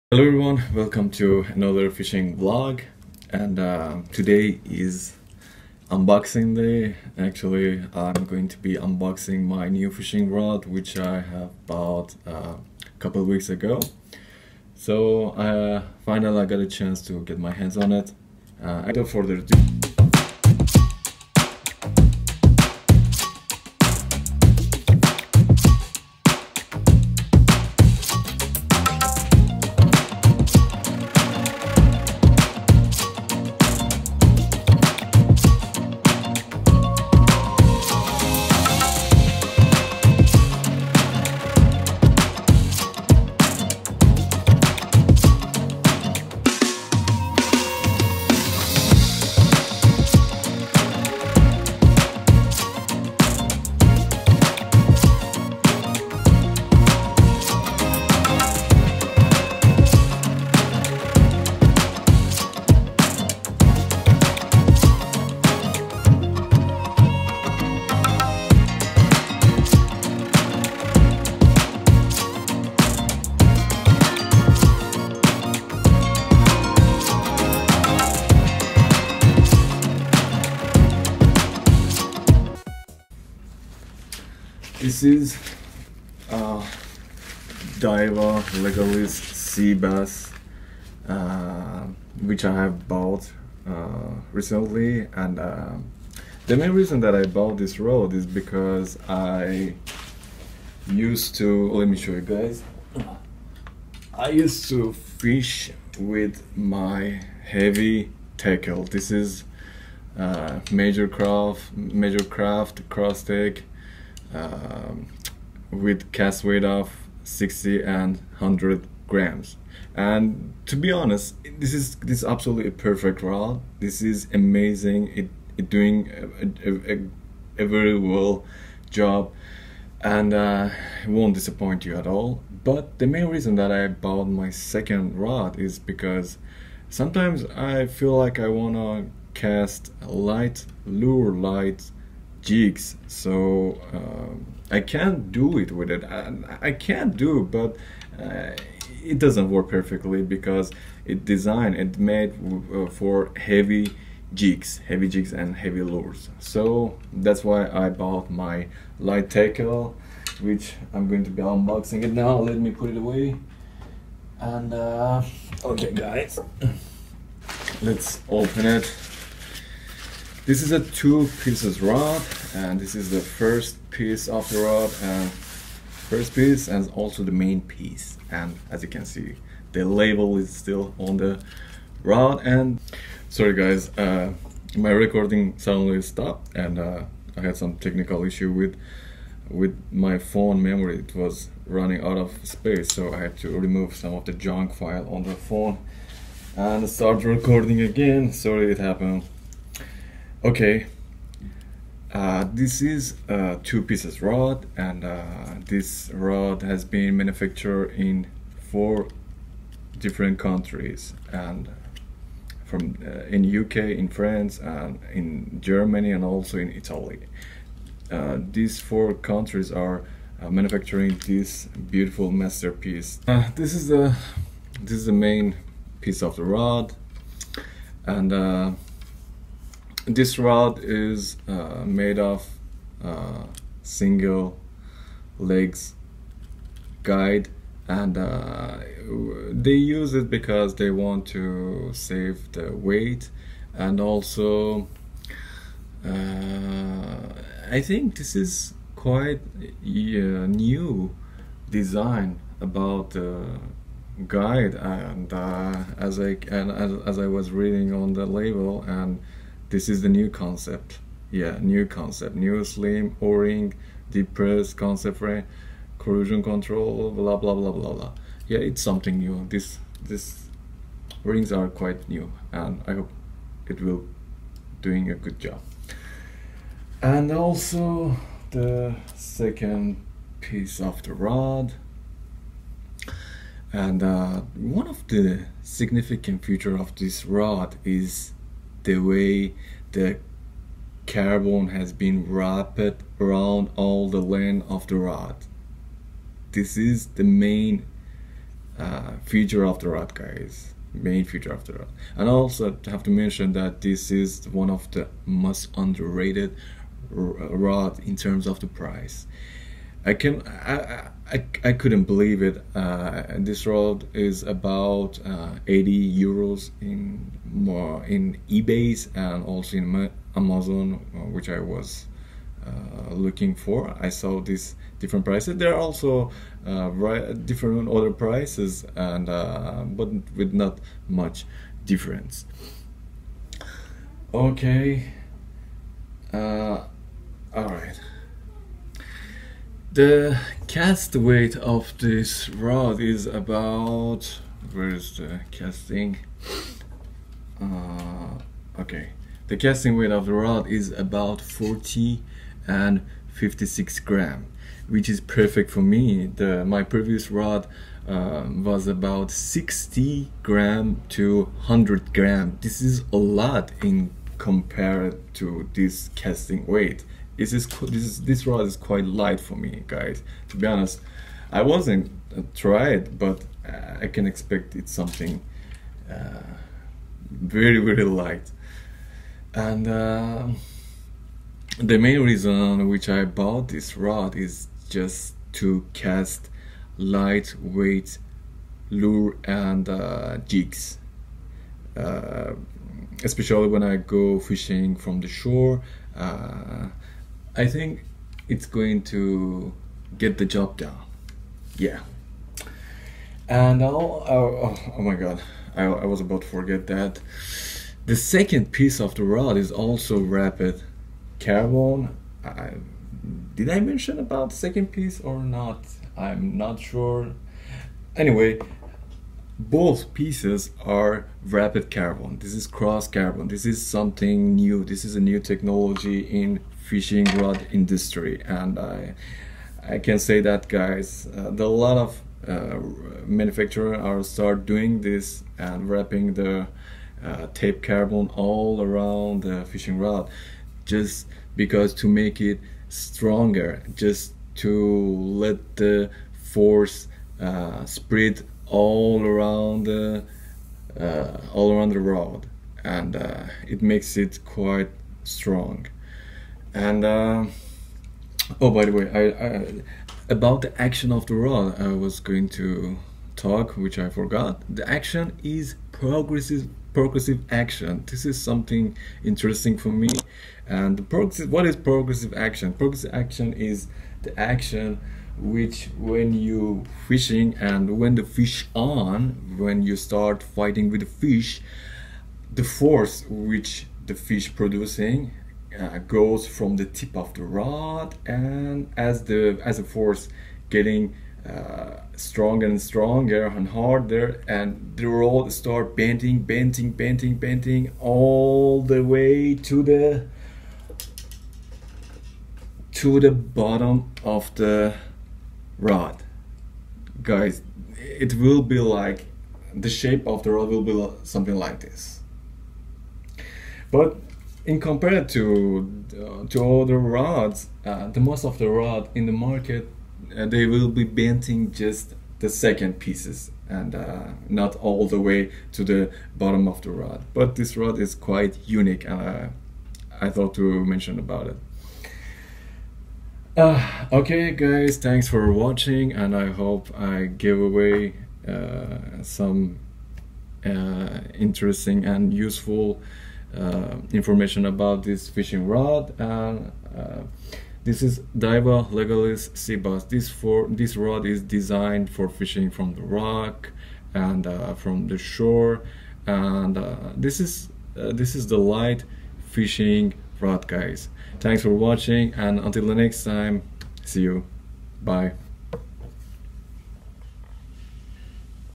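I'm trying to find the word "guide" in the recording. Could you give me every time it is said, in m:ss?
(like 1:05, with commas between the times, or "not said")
3:57, 4:14.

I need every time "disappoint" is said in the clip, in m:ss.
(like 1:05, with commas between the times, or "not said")
2:11.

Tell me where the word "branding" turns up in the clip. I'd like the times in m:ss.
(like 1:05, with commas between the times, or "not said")
not said.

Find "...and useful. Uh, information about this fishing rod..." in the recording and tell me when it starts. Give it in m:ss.
9:02.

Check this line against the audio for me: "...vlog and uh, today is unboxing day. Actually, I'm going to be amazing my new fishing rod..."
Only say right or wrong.
wrong.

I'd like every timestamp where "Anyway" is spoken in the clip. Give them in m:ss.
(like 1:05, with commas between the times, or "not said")
6:58.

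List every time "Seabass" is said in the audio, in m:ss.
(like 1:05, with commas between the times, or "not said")
1:29, 9:09.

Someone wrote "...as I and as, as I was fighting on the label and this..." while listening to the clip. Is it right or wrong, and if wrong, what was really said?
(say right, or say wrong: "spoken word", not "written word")
wrong: "reading", not "fighting".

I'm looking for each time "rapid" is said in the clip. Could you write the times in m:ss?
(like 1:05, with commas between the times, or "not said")
6:50, 7:01.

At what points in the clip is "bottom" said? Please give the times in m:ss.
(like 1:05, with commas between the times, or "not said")
8:23, 8:46.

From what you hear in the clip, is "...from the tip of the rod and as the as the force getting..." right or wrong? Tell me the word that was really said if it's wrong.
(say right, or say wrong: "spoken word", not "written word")
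right.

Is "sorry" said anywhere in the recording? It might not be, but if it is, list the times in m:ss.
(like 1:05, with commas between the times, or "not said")
3:03, 3:18.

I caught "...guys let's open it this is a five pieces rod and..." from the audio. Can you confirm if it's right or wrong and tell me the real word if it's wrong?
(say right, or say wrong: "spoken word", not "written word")
wrong: "two", not "five".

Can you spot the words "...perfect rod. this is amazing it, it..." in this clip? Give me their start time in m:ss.
2:02.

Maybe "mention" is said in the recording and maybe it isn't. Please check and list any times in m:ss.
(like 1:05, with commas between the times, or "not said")
5:03, 6:53, 8:50.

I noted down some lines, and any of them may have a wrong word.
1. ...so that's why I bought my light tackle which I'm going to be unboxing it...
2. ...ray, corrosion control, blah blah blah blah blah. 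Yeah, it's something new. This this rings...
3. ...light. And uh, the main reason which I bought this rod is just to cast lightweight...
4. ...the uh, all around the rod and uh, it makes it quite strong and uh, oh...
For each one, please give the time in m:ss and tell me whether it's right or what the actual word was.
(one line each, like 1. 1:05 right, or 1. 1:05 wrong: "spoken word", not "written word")
1. 2:36 right
2. 4:25 right
3. 6:18 right
4. 7:29 right.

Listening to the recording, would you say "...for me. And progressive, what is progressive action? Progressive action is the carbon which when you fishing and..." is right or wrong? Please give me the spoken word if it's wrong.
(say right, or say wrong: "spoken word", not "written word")
wrong: "action", not "carbon".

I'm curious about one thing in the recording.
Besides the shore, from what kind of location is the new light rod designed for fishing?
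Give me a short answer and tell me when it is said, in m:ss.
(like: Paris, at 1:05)
Rock, at 9:13.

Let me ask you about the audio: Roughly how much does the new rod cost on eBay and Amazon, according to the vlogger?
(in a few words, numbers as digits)
80 euros.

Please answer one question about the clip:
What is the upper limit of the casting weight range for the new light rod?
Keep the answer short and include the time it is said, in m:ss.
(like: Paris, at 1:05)
56 grams, at 5:53.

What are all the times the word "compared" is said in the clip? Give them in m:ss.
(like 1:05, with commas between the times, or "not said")
6:04, 8:34.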